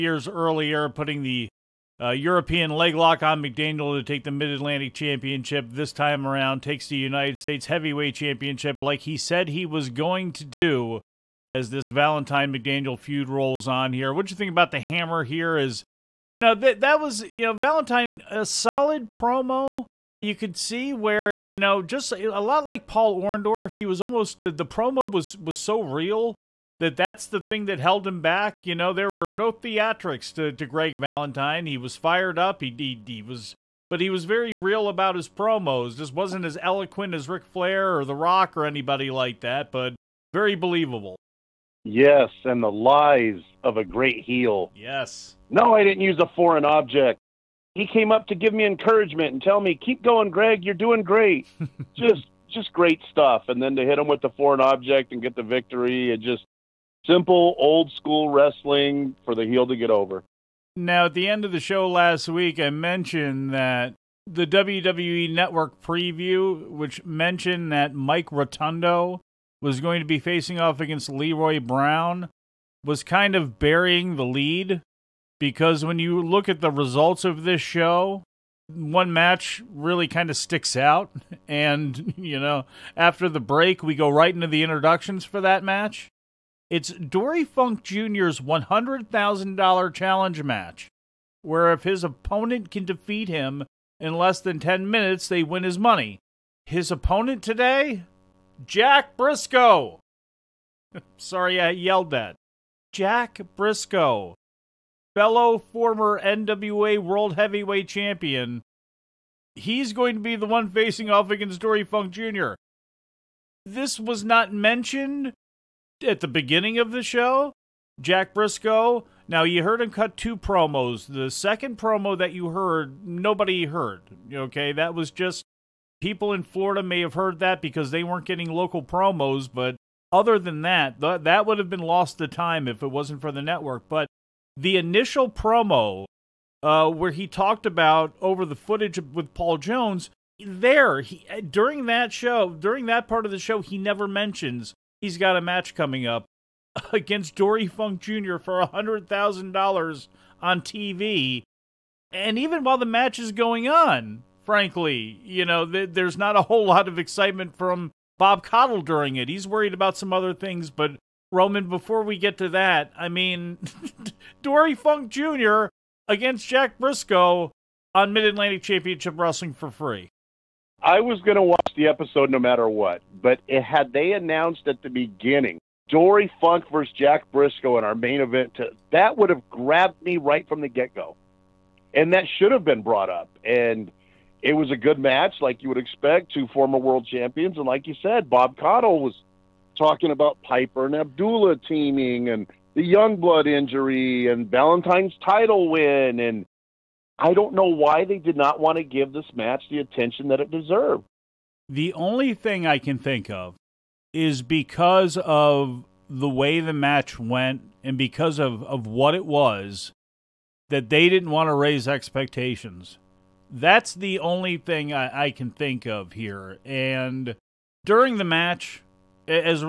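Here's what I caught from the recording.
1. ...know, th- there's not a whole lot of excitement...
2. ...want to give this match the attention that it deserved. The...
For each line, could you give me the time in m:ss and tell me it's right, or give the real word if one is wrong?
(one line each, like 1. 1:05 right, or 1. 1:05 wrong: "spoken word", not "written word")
1. 2:35 right
2. 3:18 right.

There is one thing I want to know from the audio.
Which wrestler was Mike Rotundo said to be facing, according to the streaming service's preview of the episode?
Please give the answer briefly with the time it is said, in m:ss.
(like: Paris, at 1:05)
Leroy Brown, at 1:11.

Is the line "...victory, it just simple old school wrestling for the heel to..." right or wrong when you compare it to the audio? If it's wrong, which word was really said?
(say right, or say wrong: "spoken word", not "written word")
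right.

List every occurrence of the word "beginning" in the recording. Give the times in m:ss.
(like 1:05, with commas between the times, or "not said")
1:56, 2:54.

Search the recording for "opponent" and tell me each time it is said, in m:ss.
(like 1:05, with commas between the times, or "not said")
1:32, 1:36.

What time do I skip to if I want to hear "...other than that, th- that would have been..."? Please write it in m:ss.
2:10.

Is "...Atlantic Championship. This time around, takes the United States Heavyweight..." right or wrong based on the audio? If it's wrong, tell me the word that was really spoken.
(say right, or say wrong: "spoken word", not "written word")
right.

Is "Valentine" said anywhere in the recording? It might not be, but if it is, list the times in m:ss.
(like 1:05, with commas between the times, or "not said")
0:11, 0:17, 0:30, 3:14.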